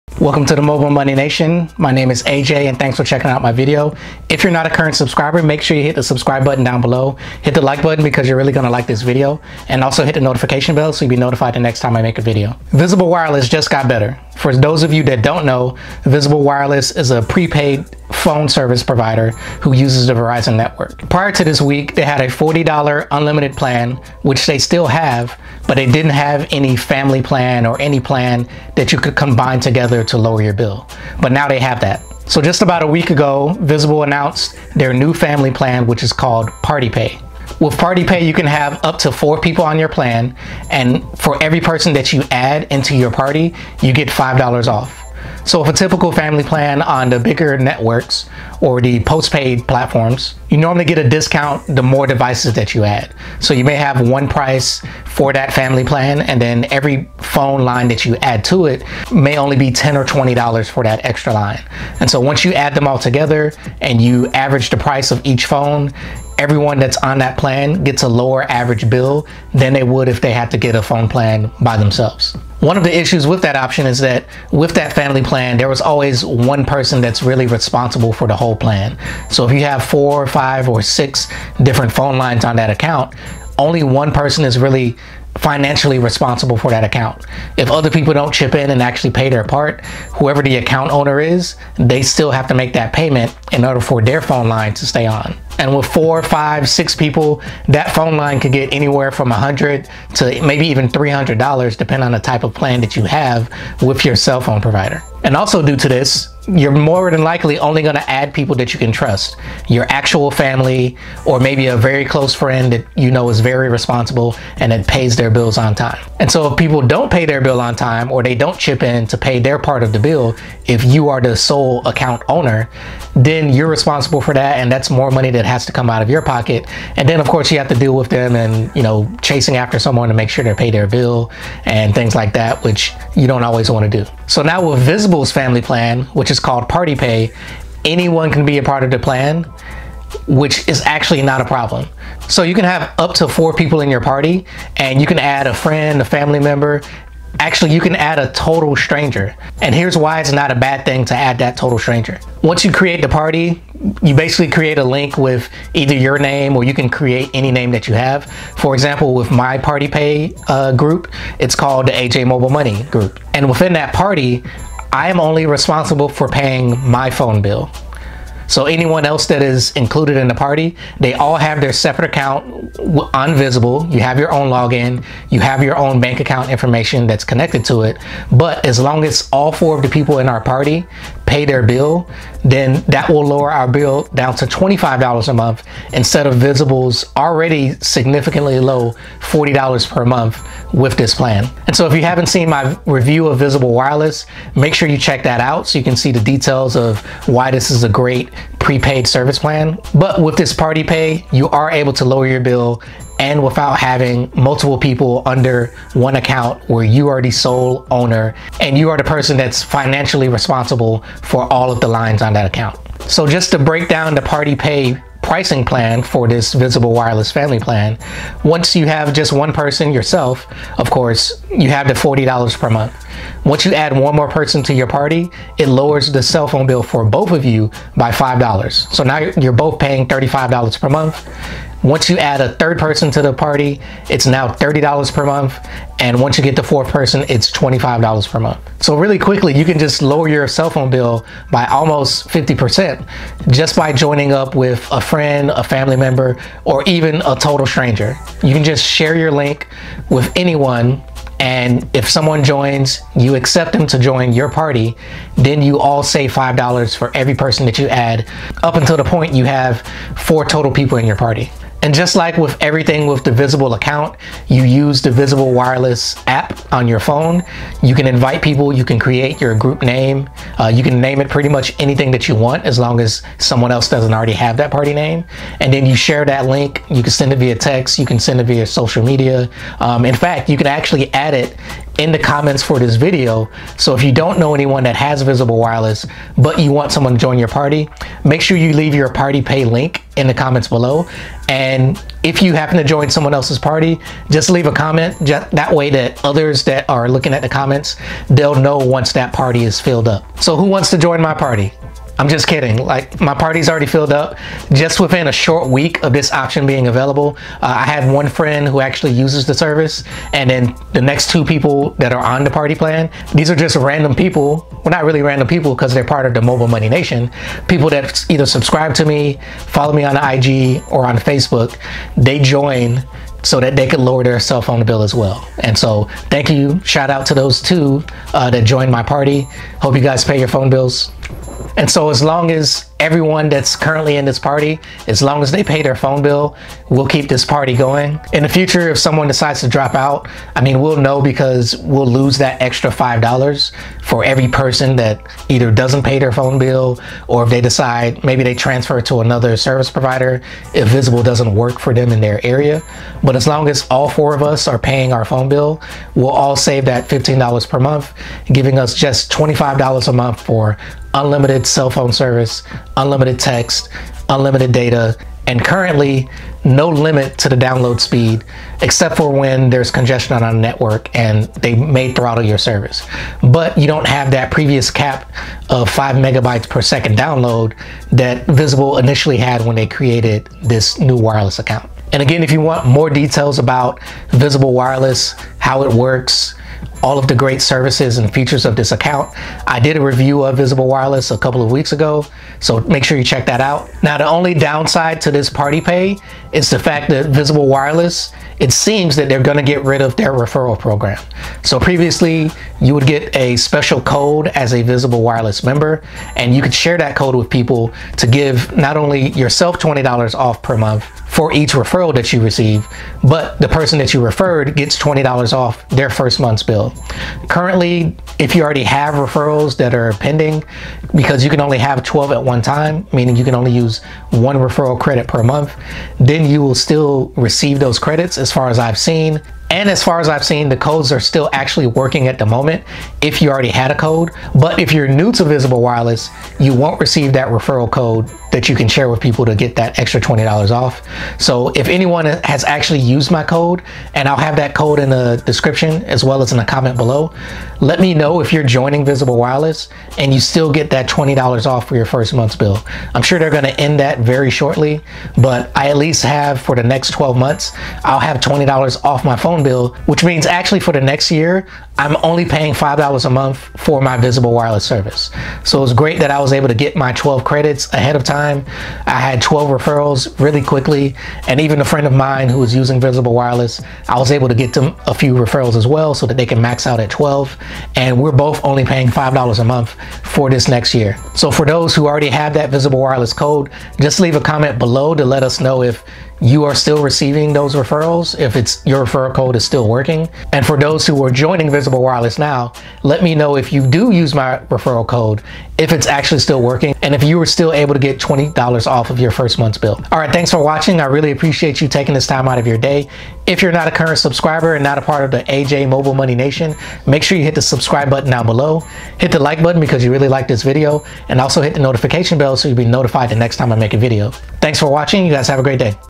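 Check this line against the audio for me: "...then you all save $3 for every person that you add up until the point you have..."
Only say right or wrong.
wrong.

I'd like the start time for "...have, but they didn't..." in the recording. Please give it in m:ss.
0:24.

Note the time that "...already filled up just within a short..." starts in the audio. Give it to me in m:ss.
5:03.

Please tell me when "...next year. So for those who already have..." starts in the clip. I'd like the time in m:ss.
8:00.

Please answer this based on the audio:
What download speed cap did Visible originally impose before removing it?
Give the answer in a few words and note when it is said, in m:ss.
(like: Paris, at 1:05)
5 megabytes per second, at 6:15.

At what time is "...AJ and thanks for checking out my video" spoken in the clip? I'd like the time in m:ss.
0:02.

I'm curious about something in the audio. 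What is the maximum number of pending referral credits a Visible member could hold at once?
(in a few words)
12.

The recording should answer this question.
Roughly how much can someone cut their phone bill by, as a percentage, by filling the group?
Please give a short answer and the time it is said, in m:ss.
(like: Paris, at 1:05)
almost 50%, at 4:01.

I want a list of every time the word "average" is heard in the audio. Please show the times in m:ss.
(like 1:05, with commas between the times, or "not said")
1:04, 1:08.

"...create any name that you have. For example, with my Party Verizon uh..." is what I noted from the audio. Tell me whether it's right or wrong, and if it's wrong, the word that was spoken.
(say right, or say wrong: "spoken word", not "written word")
wrong: "Pay", not "Verizon".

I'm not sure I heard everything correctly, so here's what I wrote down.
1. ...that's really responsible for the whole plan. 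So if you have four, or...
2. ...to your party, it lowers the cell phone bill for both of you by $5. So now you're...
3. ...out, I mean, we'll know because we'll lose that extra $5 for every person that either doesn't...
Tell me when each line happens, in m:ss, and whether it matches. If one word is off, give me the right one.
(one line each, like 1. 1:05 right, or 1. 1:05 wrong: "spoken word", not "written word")
1. 1:17 right
2. 3:44 right
3. 5:39 right.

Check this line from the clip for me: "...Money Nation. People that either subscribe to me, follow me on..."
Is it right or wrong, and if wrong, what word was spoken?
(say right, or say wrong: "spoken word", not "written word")
right.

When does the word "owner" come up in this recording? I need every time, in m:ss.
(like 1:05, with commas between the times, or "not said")
1:30, 2:02, 3:27.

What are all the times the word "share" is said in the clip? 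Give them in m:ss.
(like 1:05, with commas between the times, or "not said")
4:08, 4:35, 6:46, 7:18.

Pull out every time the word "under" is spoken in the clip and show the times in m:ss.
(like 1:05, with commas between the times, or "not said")
3:25.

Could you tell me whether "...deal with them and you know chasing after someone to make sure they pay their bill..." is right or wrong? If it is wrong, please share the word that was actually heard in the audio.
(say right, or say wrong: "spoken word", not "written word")
right.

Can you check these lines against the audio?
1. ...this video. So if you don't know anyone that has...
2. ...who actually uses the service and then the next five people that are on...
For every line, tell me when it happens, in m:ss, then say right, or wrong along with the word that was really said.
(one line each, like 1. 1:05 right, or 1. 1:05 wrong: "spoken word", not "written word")
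1. 4:42 right
2. 5:08 wrong: "two", not "five".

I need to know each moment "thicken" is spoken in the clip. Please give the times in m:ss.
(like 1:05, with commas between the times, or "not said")
not said.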